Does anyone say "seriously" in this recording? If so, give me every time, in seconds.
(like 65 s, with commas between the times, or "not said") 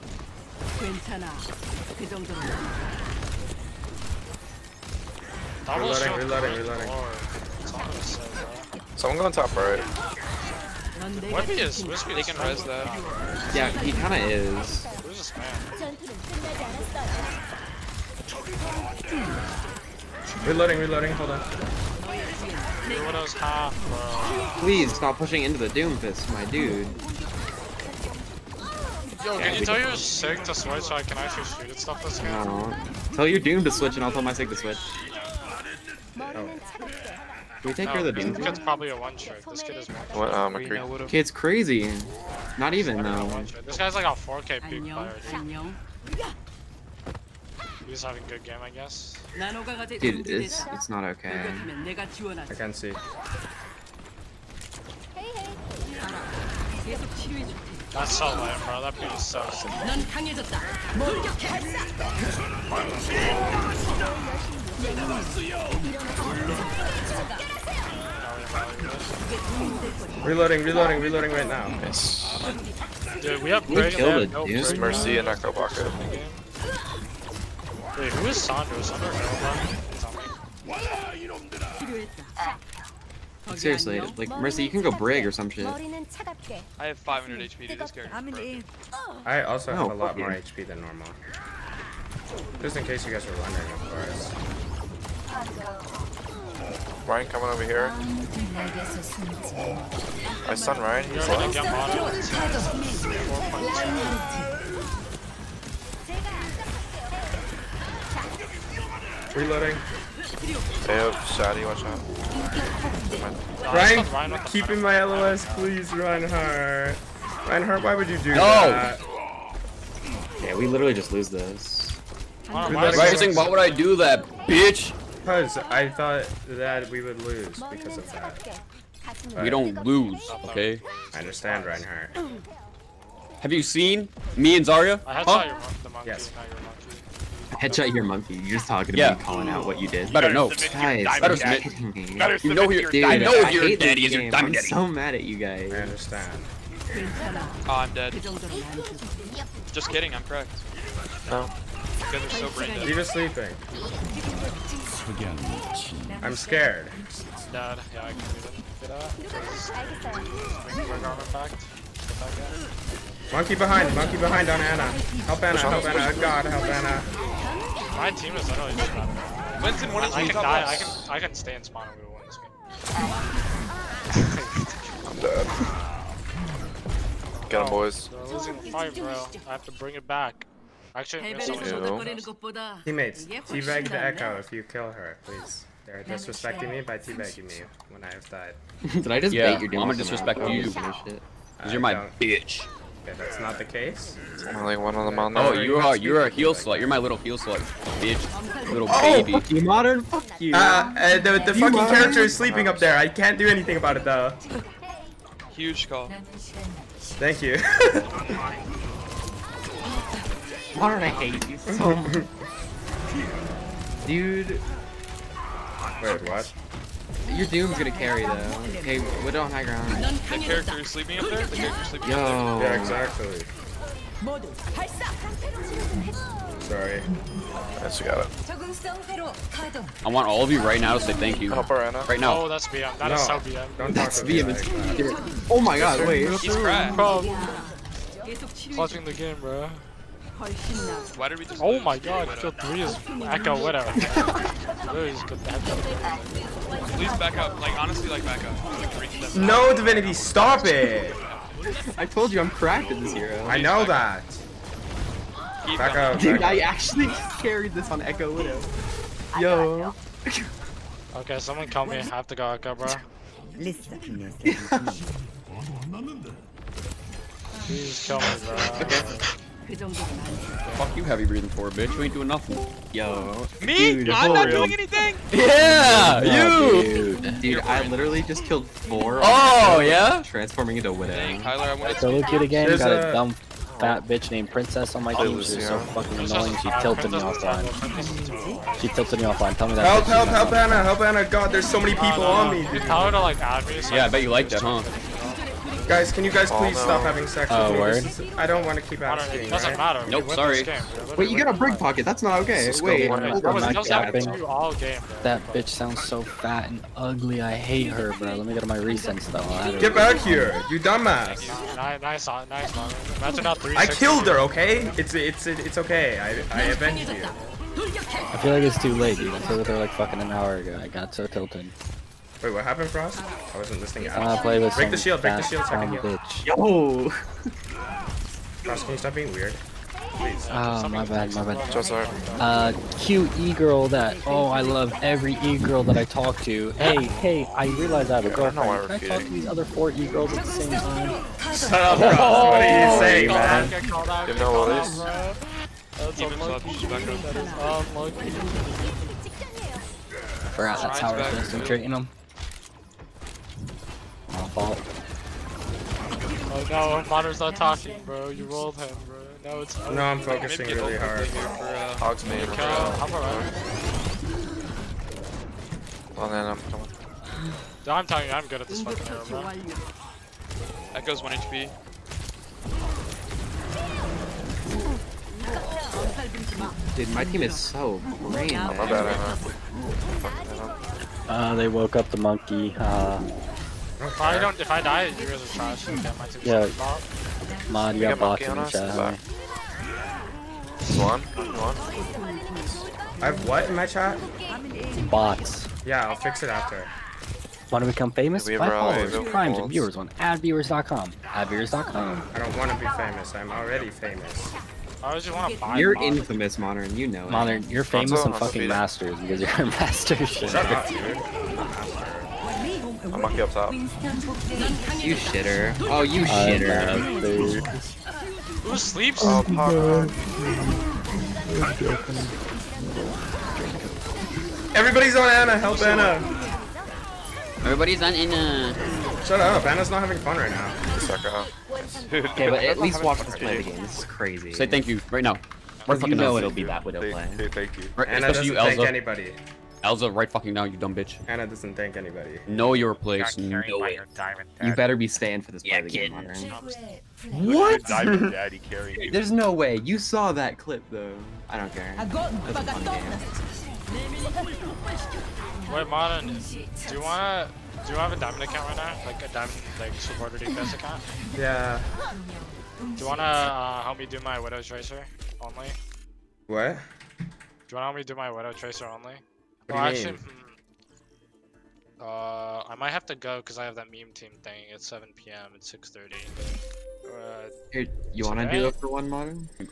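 83 s.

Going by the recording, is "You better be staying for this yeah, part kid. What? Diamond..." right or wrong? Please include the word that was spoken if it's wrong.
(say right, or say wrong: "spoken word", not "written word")
right.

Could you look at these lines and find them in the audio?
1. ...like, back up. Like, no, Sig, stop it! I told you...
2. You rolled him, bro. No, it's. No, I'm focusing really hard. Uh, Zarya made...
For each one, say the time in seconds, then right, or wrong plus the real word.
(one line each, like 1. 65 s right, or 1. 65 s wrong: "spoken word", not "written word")
1. 248 s wrong: "Divinity", not "Sig"
2. 358 s wrong: "Hogs", not "Zarya".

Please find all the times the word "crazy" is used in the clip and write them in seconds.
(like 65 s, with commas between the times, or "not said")
41 s, 434 s.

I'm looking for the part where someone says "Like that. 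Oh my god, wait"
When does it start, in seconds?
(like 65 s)
234 s.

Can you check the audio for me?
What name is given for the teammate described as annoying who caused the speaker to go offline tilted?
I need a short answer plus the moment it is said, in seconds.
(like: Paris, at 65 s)
Princess, at 284 s.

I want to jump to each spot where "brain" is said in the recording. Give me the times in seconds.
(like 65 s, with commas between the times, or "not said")
152 s, 378 s.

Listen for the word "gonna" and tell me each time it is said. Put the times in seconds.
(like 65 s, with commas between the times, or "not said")
189 s, 217 s.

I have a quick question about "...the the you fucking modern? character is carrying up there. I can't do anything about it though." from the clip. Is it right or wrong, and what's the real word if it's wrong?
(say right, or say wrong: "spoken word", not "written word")
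wrong: "sleeping", not "carrying".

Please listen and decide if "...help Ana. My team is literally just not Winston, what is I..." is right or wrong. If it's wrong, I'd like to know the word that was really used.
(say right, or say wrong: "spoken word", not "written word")
right.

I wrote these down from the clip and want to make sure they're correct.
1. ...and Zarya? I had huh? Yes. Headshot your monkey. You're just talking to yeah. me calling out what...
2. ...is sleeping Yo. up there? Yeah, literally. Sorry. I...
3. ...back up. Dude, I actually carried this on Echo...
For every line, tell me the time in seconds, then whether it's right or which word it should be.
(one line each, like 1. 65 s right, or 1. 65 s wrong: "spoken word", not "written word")
1. 134 s right
2. 221 s wrong: "exactly", not "literally"
3. 255 s right.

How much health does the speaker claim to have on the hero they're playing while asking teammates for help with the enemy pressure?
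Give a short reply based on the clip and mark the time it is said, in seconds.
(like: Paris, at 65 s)
500 HP, at 86 s.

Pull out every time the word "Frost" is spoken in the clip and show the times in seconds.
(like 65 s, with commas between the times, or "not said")
322 s, 328 s, 341 s.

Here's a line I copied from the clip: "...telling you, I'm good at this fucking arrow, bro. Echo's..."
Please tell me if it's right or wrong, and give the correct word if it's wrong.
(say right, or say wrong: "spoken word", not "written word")
right.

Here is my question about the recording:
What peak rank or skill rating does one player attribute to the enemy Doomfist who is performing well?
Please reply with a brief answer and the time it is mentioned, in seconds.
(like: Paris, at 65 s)
4k, at 44 s.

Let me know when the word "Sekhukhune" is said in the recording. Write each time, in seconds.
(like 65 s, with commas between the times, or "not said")
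not said.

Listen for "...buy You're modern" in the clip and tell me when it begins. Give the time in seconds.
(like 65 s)
405 s.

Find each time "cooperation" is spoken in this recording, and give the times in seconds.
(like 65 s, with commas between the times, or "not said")
not said.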